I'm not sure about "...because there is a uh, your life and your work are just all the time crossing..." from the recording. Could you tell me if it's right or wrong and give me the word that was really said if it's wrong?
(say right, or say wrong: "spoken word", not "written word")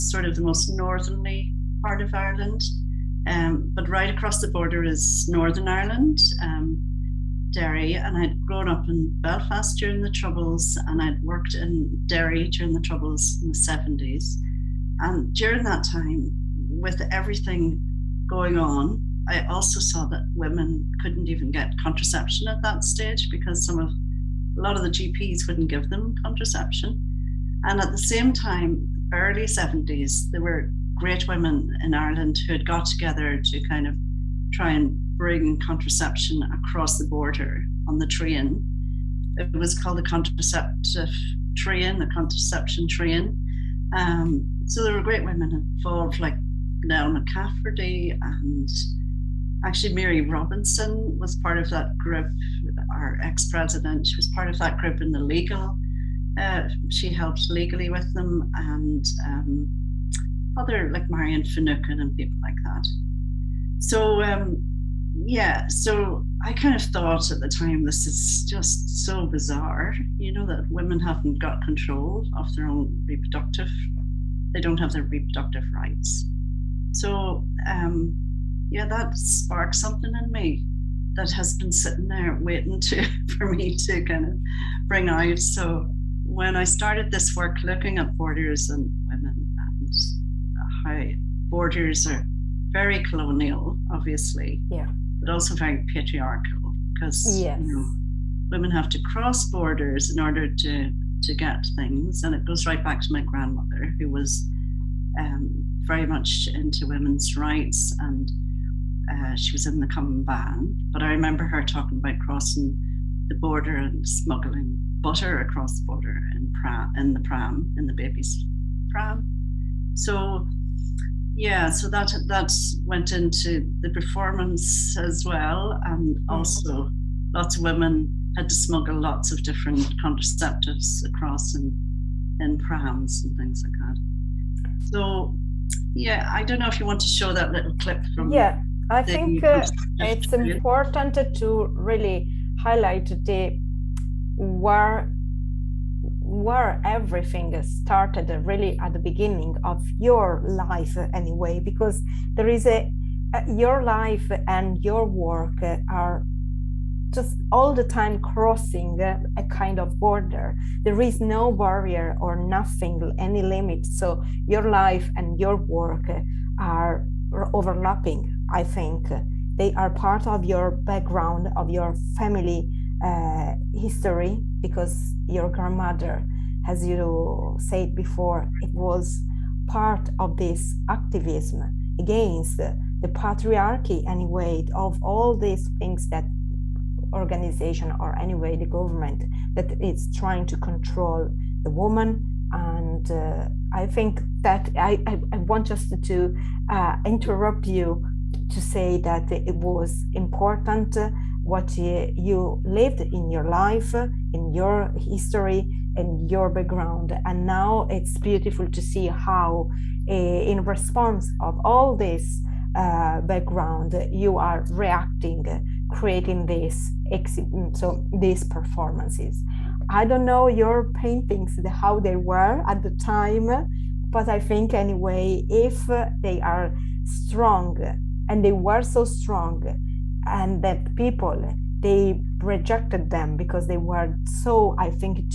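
right.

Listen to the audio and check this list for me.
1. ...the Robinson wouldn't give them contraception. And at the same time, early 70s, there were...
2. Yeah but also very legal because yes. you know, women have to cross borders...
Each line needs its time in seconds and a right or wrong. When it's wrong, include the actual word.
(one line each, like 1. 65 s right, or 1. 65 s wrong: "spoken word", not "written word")
1. 24 s wrong: "GPs", not "Robinson"
2. 94 s wrong: "patriarchal", not "legal".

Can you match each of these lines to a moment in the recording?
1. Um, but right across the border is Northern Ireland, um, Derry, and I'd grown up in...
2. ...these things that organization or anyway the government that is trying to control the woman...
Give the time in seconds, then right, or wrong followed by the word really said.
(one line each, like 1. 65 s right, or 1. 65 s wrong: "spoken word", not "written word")
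1. 3 s right
2. 185 s right.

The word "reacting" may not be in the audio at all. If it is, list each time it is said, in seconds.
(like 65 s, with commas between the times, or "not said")
214 s.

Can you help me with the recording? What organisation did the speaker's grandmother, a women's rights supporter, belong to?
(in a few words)
Cumann na mBan.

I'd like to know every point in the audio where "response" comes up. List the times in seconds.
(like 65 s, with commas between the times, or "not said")
210 s.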